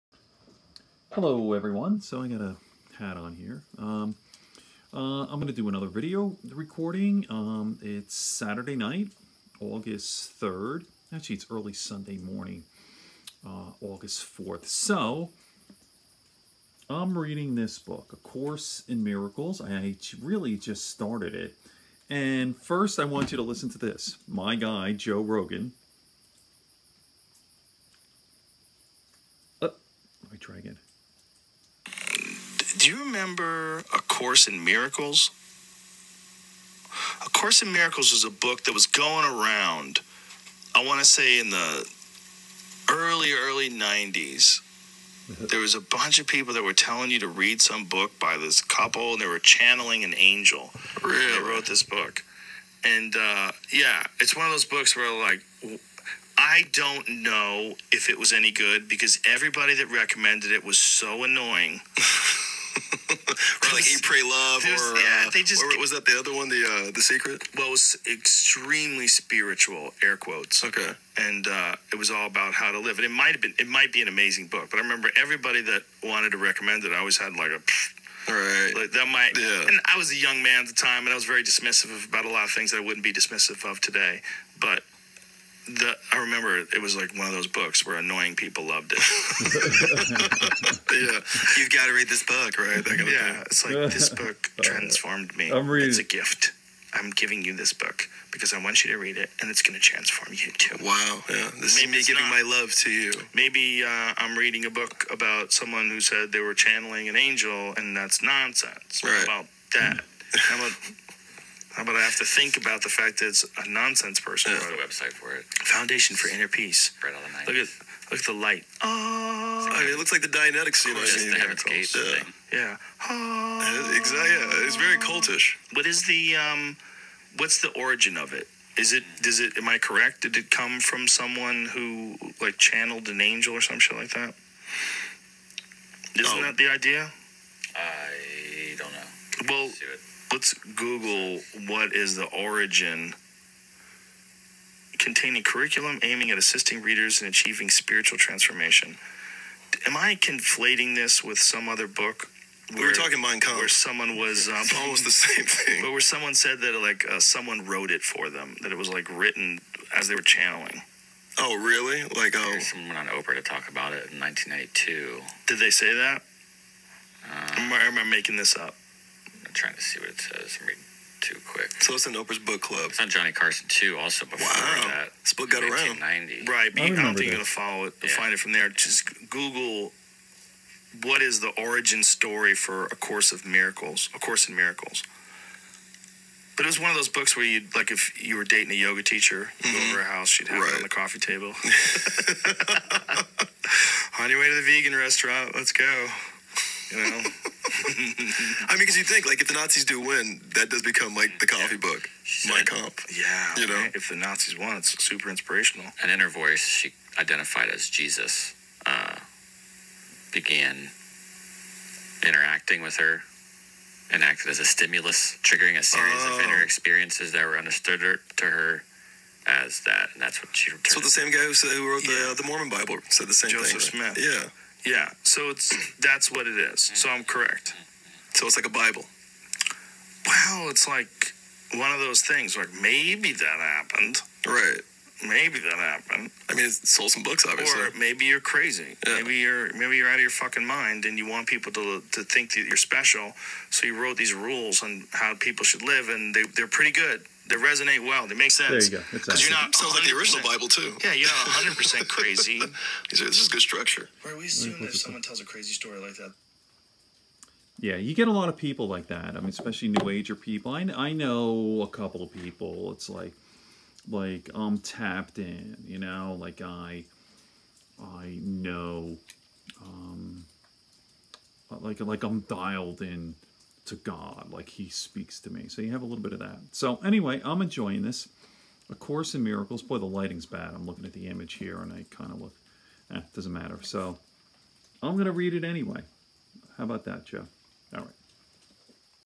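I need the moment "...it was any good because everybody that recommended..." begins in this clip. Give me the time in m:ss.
0:58.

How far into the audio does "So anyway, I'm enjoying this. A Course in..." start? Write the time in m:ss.
4:36.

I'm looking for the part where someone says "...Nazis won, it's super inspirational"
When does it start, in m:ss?
3:24.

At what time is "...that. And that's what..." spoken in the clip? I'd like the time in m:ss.
3:39.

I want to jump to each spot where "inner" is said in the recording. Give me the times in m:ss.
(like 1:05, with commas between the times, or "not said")
1:56, 3:36.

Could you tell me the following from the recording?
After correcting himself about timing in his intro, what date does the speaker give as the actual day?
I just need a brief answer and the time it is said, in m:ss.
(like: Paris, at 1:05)
August 4th, at 0:13.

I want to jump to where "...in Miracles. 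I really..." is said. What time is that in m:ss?
0:18.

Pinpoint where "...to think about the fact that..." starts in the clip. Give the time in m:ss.
1:52.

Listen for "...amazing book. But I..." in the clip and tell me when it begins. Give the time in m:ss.
1:14.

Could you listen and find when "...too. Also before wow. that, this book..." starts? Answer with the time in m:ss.
2:53.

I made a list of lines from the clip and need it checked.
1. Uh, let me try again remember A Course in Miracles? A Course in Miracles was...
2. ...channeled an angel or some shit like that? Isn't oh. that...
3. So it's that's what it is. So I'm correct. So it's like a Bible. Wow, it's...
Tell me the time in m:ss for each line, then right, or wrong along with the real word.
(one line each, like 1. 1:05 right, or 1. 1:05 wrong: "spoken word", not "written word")
1. 0:29 right
2. 2:12 right
3. 3:45 right.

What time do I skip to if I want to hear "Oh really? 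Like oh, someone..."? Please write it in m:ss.
2:41.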